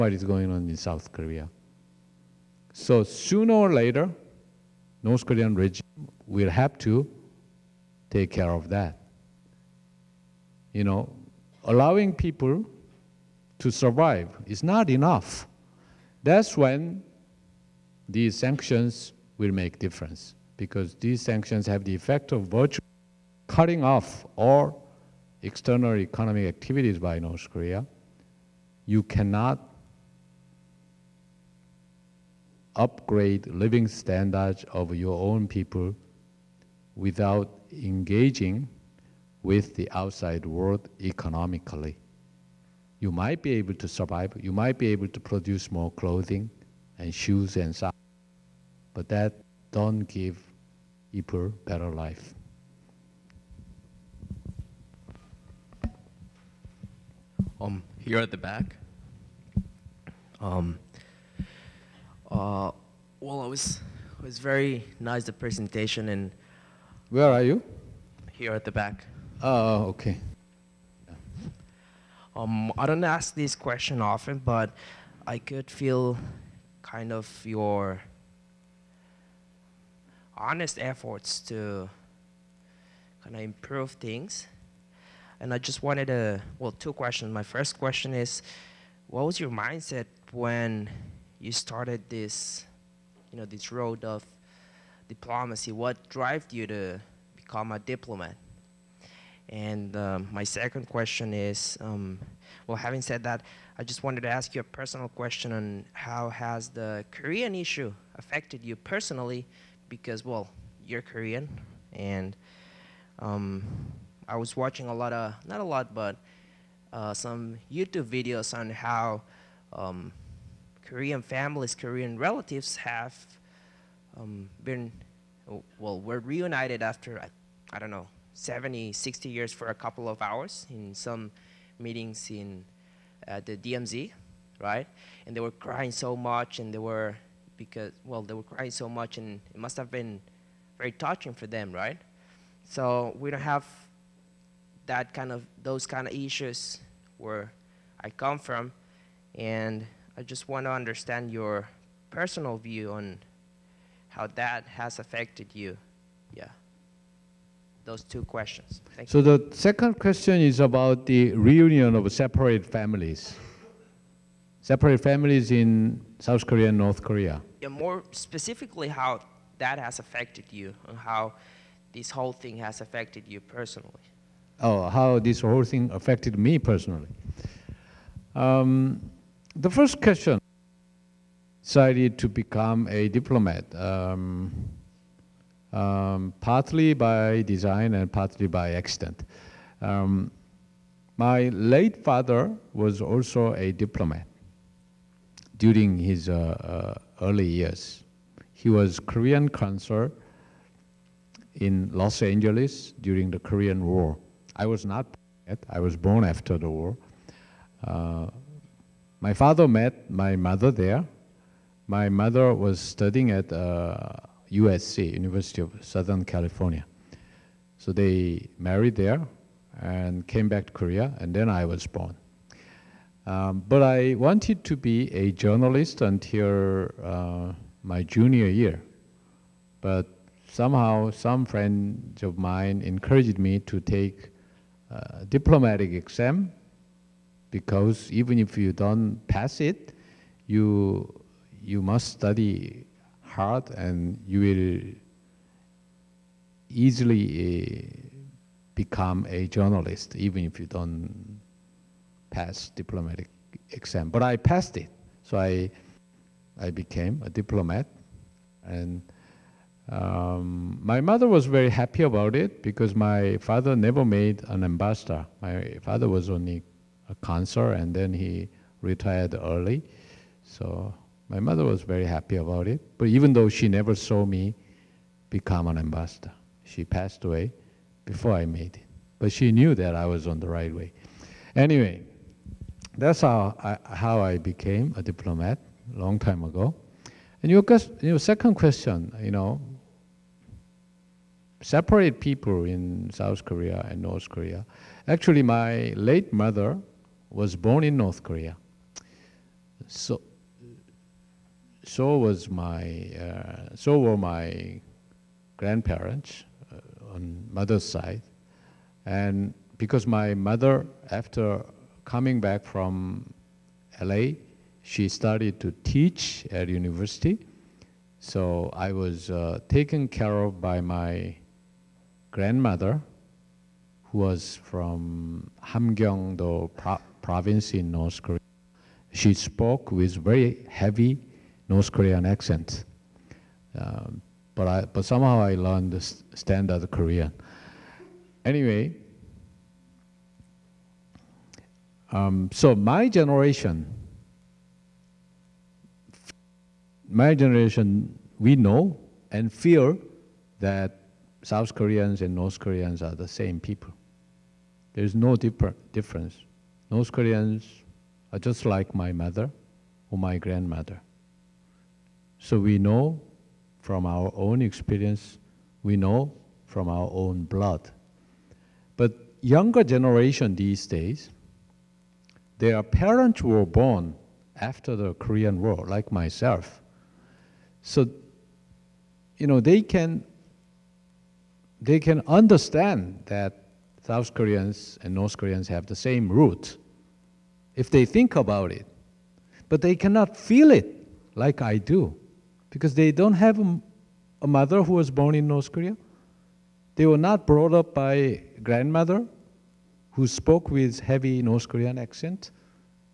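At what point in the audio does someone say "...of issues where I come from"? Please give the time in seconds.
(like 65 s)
146 s.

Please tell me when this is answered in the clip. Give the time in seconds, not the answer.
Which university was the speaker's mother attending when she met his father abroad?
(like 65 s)
214 s.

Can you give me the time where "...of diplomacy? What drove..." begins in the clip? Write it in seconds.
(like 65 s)
94 s.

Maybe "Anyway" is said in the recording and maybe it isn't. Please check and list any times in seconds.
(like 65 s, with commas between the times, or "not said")
281 s, 338 s.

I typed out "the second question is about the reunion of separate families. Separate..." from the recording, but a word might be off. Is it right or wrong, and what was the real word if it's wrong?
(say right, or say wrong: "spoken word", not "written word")
right.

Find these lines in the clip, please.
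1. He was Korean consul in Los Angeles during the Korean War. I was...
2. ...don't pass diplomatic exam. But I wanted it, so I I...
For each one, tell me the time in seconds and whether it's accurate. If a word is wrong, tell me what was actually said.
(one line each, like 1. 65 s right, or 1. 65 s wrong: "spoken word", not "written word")
1. 198 s right
2. 250 s wrong: "passed", not "wanted".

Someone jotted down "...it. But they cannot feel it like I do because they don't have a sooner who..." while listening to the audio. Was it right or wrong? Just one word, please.
wrong.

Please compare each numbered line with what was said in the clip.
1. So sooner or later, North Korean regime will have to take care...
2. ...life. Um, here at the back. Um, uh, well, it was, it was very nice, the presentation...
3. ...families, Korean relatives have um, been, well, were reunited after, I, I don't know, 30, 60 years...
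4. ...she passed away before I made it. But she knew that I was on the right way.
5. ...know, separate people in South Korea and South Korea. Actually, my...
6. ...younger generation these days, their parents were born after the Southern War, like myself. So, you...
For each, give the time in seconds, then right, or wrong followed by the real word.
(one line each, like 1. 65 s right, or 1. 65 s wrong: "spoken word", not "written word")
1. 2 s right
2. 51 s right
3. 121 s wrong: "70", not "30"
4. 276 s right
5. 289 s wrong: "North", not "South"
6. 369 s wrong: "Korean", not "Southern".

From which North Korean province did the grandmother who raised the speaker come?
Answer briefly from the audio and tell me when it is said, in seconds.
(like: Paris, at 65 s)
Hamgyeongdo, at 325 s.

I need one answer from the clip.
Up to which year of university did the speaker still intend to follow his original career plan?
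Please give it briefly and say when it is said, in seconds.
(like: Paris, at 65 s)
Junior year, at 228 s.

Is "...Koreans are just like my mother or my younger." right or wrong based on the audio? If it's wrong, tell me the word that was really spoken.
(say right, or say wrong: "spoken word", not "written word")
wrong: "grandmother", not "younger".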